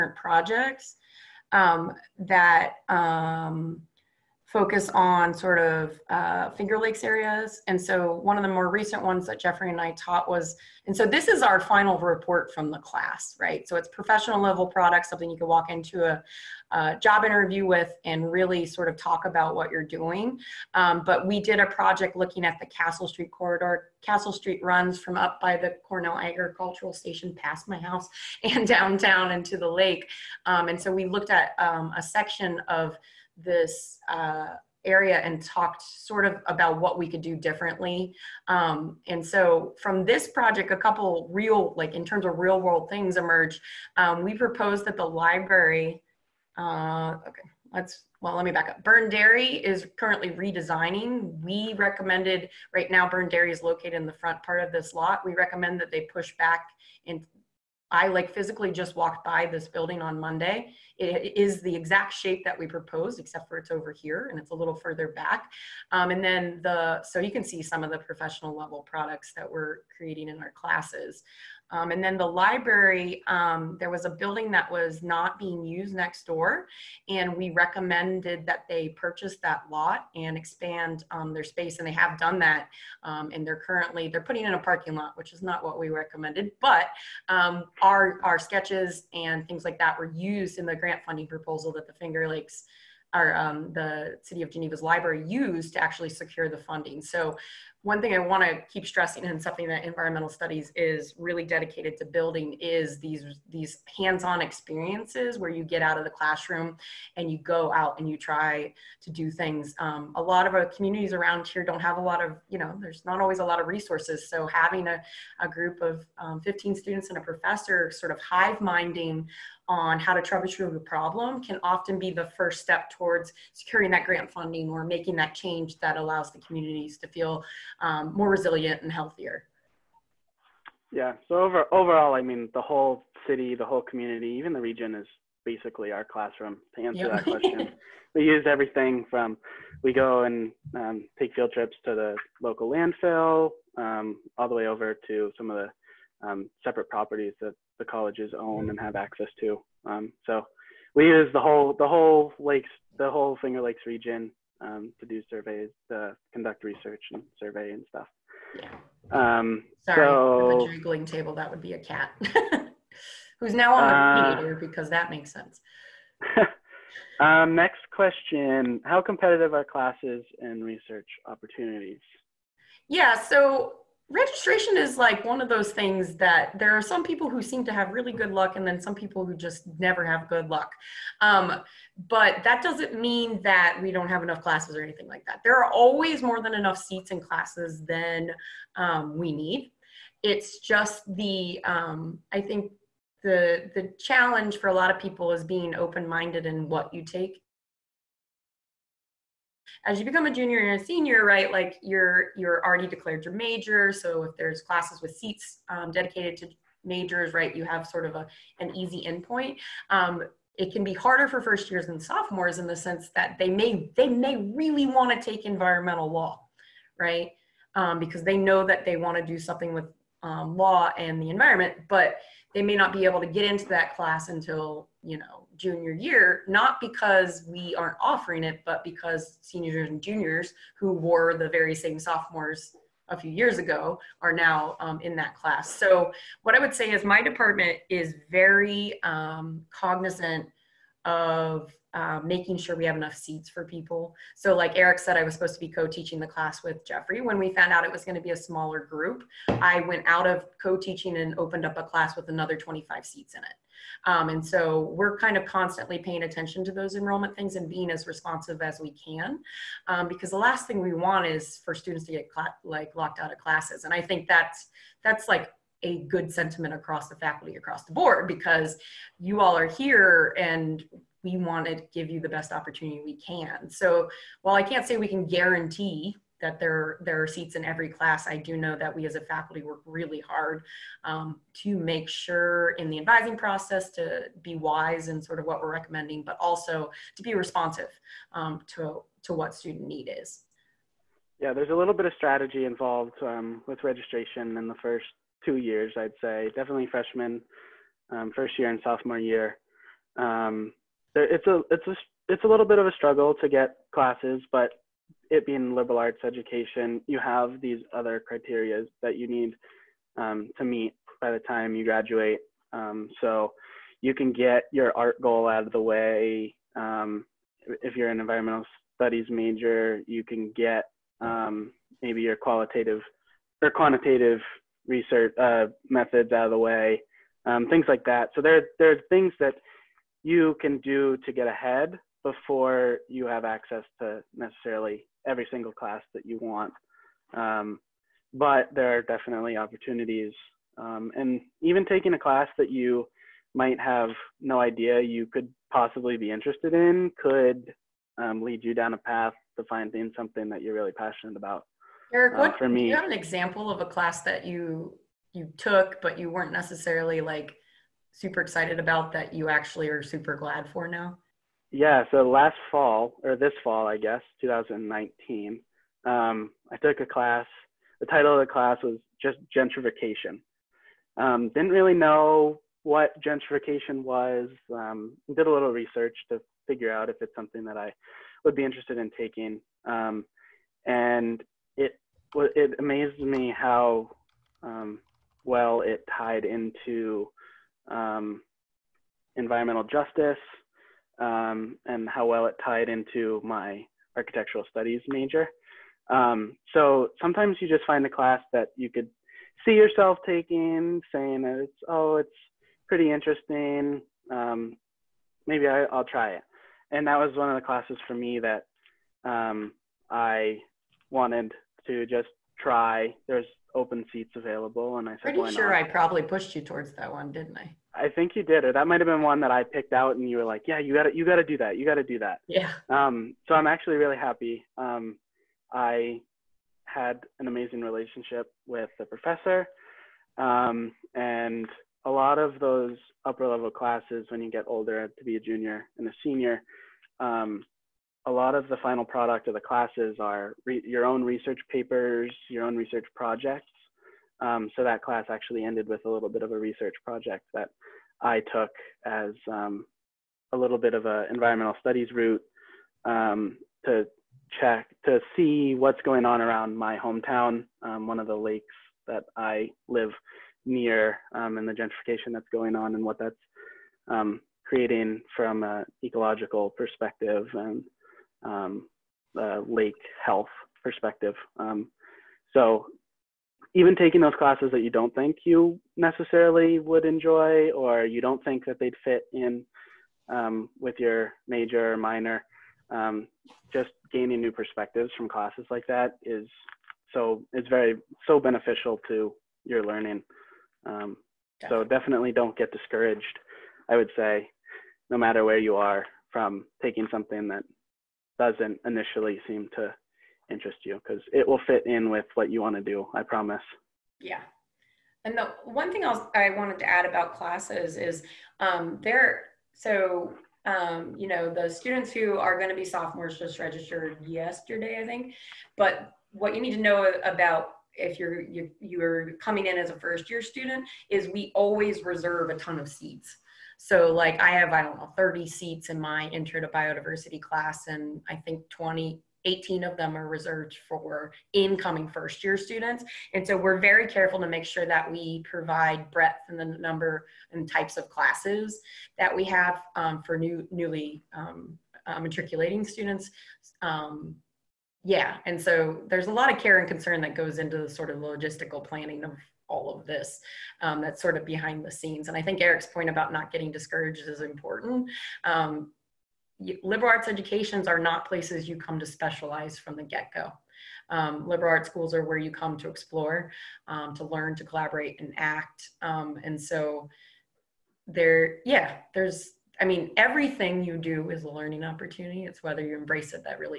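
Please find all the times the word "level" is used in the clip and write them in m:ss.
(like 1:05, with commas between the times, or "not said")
0:14, 1:08, 7:13.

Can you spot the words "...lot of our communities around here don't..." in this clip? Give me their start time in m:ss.
1:50.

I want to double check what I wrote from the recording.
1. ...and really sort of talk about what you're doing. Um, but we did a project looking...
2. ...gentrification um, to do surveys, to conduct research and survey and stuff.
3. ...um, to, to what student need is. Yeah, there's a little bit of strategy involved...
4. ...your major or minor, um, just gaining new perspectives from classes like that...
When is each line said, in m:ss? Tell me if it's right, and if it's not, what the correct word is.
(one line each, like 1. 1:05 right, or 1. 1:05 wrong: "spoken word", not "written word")
1. 0:18 right
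2. 2:33 wrong: "region", not "gentrification"
3. 4:48 right
4. 8:00 right.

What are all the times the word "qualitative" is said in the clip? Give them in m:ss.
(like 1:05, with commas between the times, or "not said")
5:22.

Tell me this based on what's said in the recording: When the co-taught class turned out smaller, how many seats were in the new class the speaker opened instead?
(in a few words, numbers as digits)
25.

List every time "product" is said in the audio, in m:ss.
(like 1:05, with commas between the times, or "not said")
0:14, 1:08, 7:19.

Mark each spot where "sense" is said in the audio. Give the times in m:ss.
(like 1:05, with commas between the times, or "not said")
2:45, 3:32.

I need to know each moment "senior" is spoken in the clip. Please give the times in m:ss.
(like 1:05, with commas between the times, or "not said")
3:20, 3:49, 7:16.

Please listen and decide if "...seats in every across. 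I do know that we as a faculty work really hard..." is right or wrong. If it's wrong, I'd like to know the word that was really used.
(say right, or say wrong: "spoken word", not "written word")
wrong: "class", not "across".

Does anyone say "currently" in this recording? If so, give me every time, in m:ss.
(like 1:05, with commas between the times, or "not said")
0:49, 1:23.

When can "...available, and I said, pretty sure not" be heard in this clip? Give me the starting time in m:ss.
6:54.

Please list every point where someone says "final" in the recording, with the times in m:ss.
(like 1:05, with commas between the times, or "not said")
0:11, 7:18.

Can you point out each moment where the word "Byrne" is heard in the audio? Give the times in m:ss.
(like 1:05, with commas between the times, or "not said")
0:48, 0:53.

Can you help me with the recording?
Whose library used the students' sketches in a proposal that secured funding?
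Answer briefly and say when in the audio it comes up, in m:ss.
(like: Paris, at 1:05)
City of Geneva, at 1:34.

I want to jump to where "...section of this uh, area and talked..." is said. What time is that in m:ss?
0:32.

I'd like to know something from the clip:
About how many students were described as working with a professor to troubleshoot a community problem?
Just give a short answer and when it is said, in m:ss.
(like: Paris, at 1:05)
15, at 1:56.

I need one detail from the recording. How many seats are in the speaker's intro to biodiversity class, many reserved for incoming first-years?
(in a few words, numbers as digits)
30.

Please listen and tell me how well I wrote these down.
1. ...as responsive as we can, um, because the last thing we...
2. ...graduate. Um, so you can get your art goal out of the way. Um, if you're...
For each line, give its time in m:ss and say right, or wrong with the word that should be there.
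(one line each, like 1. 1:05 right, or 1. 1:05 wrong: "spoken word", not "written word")
1. 4:17 right
2. 5:11 right.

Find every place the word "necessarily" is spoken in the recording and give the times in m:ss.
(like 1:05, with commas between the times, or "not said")
5:34, 5:56, 7:55.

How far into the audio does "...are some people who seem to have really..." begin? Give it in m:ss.
2:56.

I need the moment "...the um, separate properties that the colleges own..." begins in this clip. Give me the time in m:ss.
2:25.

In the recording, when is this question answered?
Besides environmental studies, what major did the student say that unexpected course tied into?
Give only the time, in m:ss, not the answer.
6:34.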